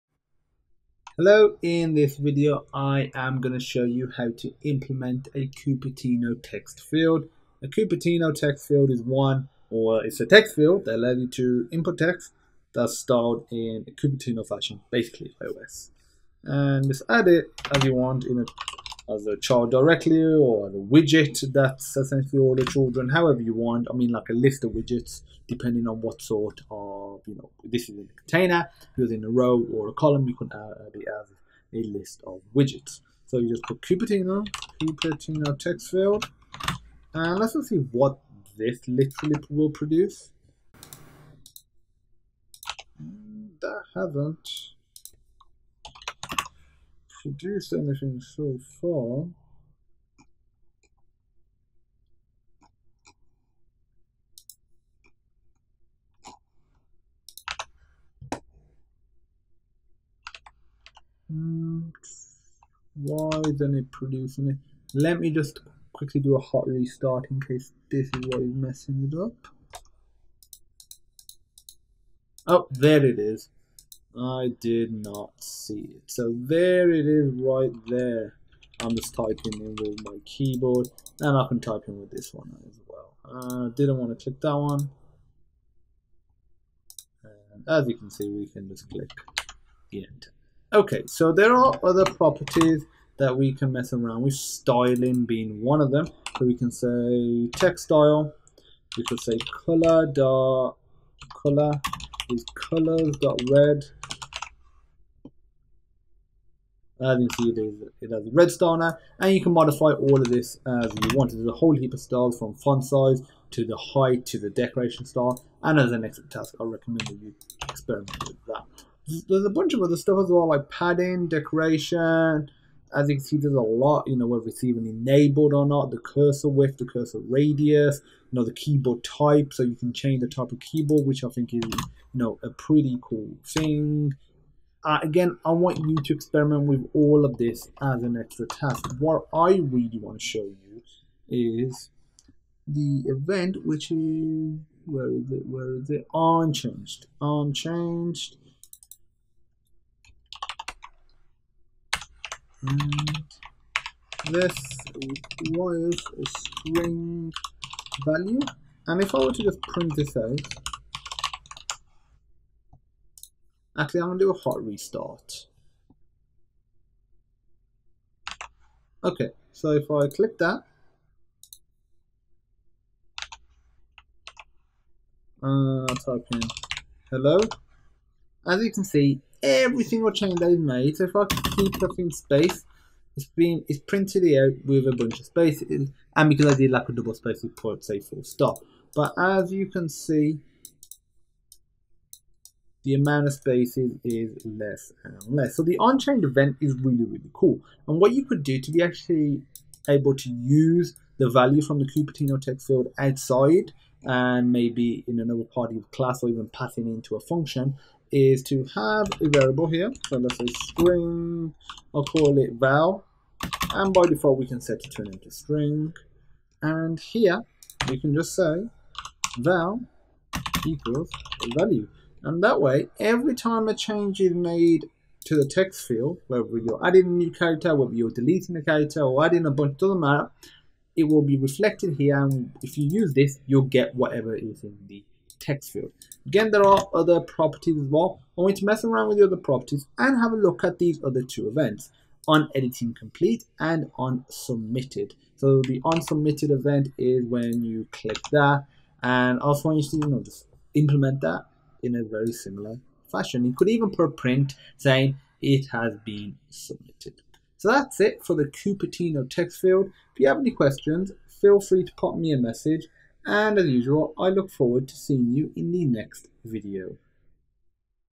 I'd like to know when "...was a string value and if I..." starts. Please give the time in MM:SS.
02:35.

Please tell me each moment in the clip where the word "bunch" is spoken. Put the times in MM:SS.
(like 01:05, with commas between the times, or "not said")
01:59, 03:04, 03:49.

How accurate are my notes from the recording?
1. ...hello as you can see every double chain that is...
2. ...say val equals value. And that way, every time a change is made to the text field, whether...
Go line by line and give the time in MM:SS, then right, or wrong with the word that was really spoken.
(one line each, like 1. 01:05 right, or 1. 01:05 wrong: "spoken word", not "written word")
1. 02:57 wrong: "single", not "double"
2. 03:38 right.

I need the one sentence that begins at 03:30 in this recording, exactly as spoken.
So let's say string, I'll call it val.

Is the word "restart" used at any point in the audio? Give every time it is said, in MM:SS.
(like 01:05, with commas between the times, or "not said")
01:06, 02:44.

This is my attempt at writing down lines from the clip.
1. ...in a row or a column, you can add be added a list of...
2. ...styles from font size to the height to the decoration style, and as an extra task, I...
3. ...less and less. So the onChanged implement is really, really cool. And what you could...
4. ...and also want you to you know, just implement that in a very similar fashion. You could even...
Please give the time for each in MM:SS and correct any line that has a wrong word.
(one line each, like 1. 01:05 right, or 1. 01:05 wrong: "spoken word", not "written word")
1. 00:29 right
2. 01:51 right
3. 03:14 wrong: "event", not "implement"
4. 04:09 right.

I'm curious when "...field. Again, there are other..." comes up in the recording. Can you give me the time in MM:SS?
03:55.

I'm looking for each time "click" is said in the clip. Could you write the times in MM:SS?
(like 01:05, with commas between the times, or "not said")
01:24, 01:28, 02:50, 04:07.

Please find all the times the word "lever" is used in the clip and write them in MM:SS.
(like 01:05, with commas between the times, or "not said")
not said.